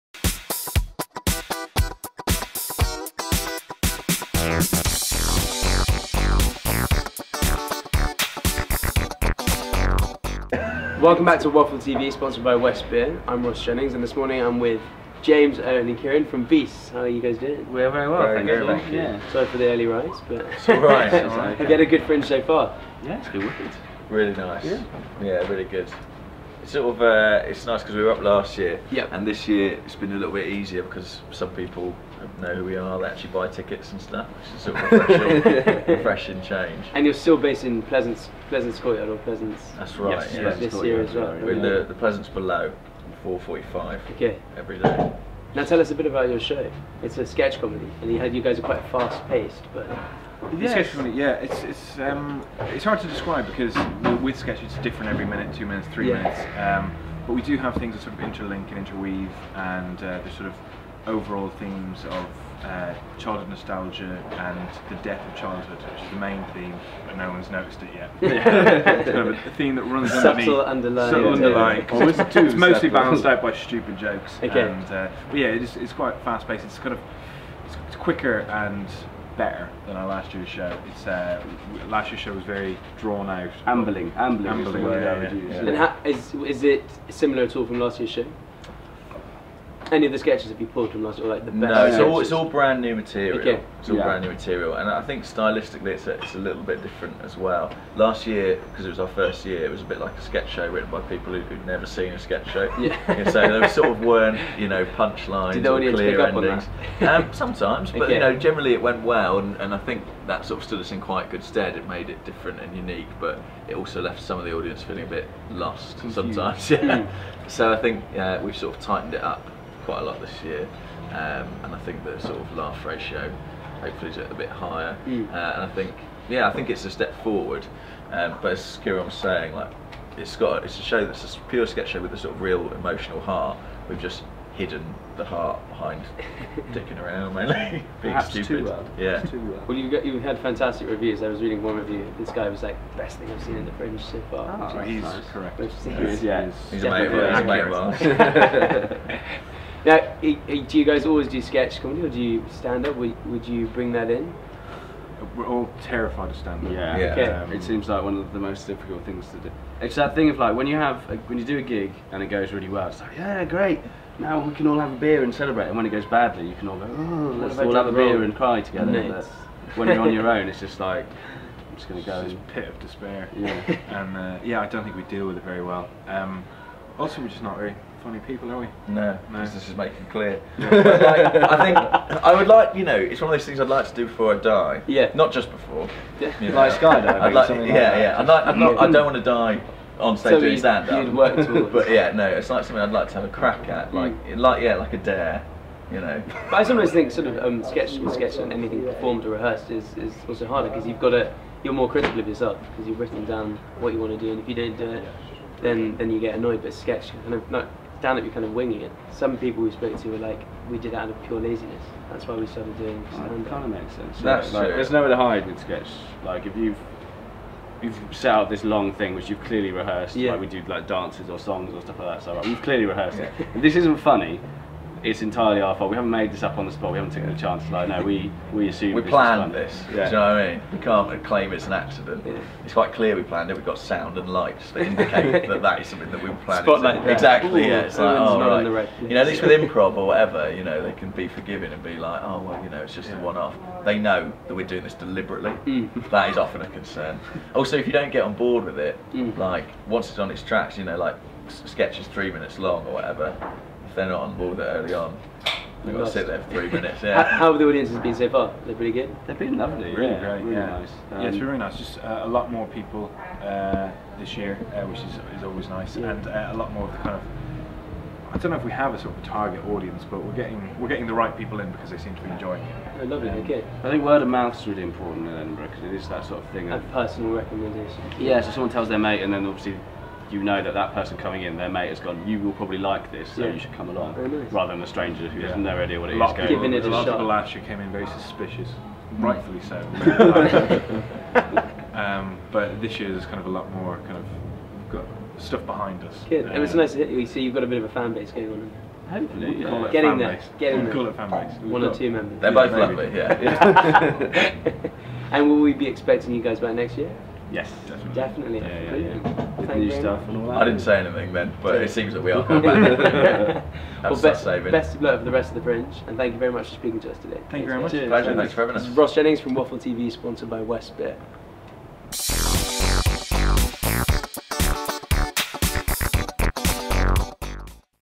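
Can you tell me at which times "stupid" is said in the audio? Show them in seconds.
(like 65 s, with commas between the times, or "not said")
73 s, 138 s.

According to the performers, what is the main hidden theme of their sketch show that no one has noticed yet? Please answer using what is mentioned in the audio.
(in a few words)
The death of childhood.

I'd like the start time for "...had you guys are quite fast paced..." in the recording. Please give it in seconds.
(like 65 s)
48 s.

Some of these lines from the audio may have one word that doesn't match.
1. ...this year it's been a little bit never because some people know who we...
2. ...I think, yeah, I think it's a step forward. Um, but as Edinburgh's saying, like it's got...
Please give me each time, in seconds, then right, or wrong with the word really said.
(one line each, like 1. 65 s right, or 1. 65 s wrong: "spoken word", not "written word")
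1. 29 s wrong: "easier", not "never"
2. 125 s wrong: "Kieran", not "Edinburgh".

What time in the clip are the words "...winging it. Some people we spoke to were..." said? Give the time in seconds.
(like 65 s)
208 s.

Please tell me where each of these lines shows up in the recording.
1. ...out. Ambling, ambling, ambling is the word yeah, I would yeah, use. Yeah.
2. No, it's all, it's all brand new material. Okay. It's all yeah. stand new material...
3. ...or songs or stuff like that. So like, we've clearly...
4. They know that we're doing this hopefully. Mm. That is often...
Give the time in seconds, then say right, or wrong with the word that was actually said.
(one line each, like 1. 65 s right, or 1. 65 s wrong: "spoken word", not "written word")
1. 83 s right
2. 91 s wrong: "brand", not "stand"
3. 221 s right
4. 243 s wrong: "deliberately", not "hopefully".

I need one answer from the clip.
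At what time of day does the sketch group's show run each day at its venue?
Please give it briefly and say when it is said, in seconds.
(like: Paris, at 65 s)
4:45, at 43 s.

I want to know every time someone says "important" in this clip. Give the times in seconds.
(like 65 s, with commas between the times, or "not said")
274 s.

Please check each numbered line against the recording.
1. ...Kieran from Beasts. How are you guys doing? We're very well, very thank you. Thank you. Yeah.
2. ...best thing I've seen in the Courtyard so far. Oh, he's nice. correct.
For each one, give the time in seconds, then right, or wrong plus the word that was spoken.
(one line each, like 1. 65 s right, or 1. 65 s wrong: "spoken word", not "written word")
1. 15 s right
2. 142 s wrong: "Fringe", not "Courtyard".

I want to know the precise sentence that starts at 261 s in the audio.
Just uh, a lot more people uh, this year, uh, which is, is always nice, yeah.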